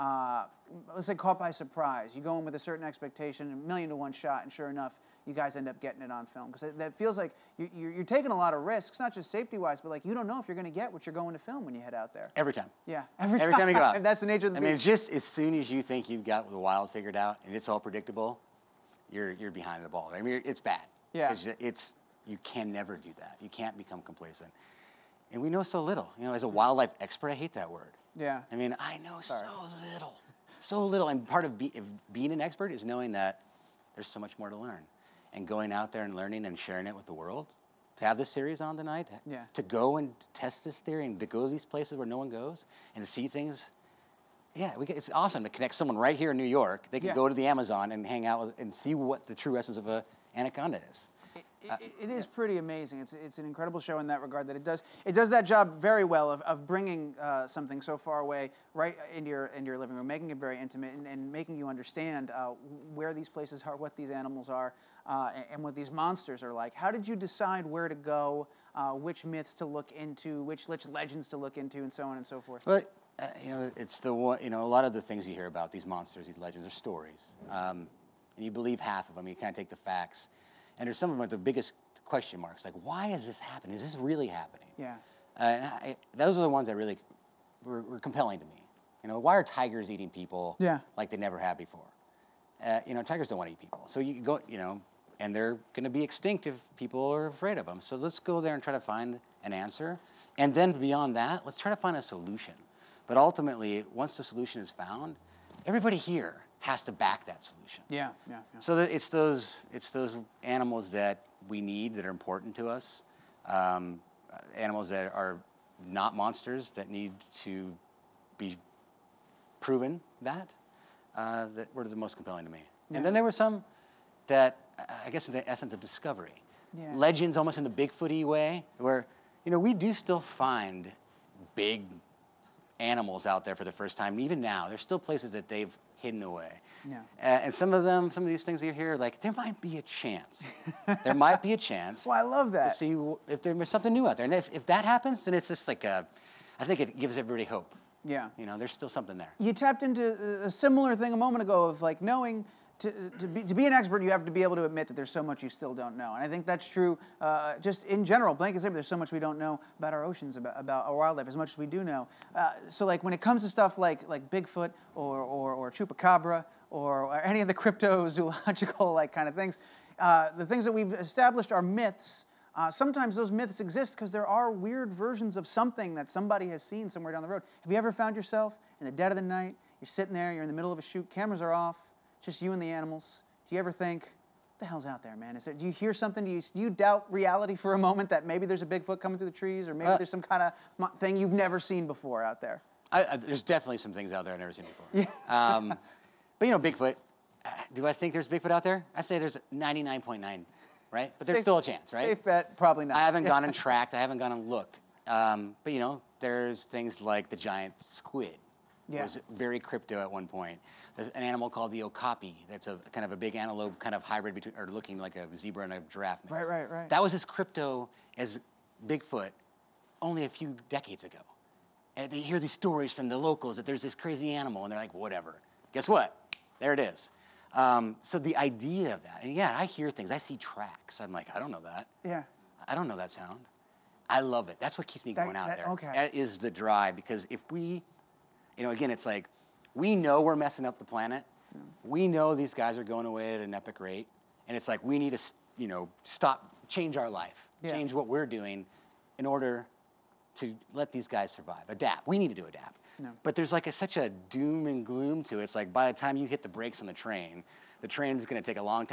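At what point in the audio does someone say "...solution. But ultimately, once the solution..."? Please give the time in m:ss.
1:42.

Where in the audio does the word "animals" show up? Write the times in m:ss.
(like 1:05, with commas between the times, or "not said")
1:04, 1:50, 1:54, 2:12, 3:02, 3:31, 3:44.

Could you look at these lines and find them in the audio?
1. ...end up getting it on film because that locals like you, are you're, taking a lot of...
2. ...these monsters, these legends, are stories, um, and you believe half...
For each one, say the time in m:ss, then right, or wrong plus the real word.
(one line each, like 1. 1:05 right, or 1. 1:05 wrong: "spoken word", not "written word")
1. 0:05 wrong: "feels", not "locals"
2. 1:15 right.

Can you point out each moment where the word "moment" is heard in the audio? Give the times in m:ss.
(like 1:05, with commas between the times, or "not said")
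2:31, 3:07.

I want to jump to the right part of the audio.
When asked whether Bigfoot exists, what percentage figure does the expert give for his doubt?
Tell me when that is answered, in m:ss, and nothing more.
3:19.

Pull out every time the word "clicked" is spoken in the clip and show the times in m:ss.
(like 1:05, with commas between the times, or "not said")
not said.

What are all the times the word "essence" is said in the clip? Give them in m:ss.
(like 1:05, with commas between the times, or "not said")
0:49, 2:05.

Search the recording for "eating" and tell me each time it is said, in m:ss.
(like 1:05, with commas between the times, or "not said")
1:29.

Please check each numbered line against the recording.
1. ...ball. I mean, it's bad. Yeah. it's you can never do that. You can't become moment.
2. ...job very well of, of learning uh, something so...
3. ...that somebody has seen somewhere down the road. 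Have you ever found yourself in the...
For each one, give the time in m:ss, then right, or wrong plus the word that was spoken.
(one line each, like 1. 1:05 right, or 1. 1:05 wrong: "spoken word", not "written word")
1. 0:19 wrong: "complacent", not "moment"
2. 0:55 wrong: "bringing", not "learning"
3. 2:55 right.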